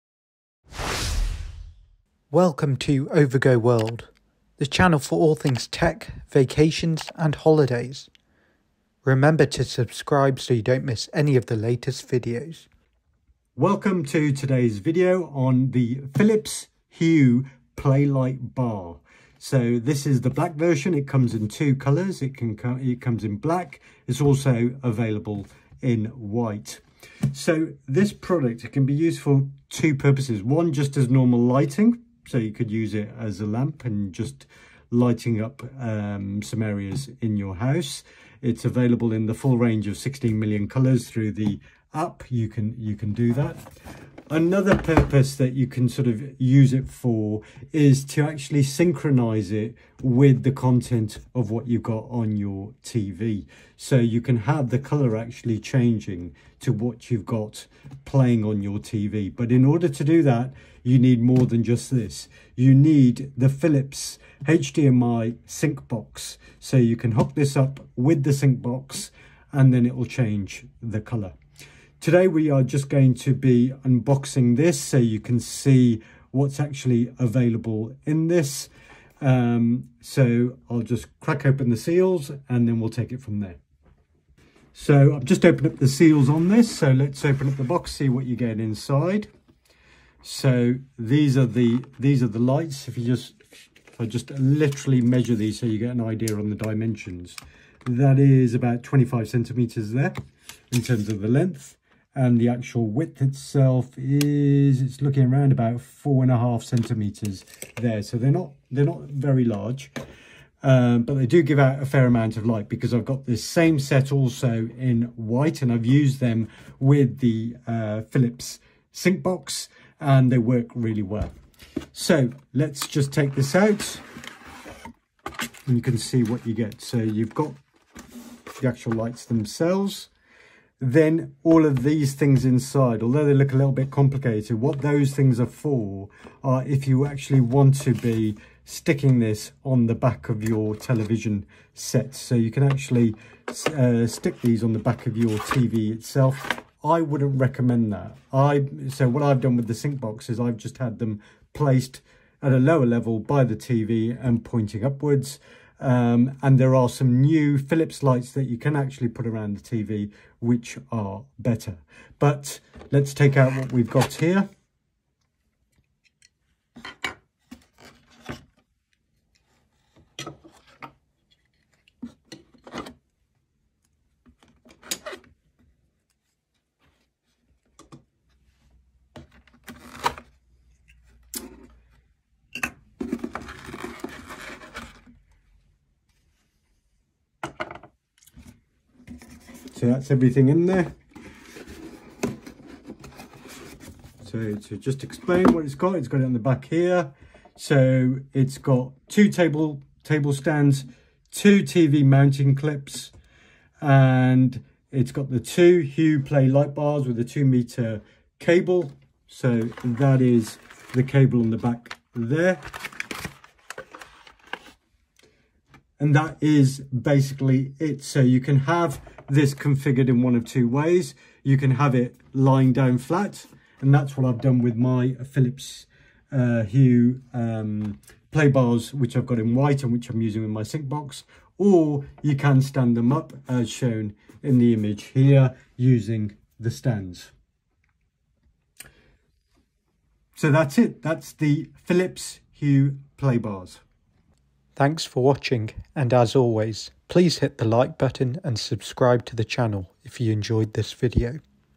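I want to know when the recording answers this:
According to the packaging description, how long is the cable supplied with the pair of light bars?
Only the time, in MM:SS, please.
03:27.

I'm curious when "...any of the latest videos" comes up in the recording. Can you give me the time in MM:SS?
00:11.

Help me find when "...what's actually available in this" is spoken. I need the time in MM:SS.
01:16.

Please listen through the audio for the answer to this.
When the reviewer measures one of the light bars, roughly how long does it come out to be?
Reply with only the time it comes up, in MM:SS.
01:38.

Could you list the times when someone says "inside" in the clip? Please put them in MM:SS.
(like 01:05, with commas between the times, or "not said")
01:28, 02:12.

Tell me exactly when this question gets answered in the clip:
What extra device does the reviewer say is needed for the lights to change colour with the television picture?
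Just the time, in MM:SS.
01:03.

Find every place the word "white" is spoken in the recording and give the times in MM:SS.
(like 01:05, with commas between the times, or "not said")
00:26, 01:55, 03:49.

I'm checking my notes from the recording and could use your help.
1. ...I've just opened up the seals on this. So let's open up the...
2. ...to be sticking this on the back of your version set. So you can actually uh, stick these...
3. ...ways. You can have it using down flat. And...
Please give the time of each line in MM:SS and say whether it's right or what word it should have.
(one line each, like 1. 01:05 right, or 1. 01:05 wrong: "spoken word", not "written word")
1. 01:25 right
2. 02:17 wrong: "television", not "version"
3. 03:40 wrong: "lying", not "using".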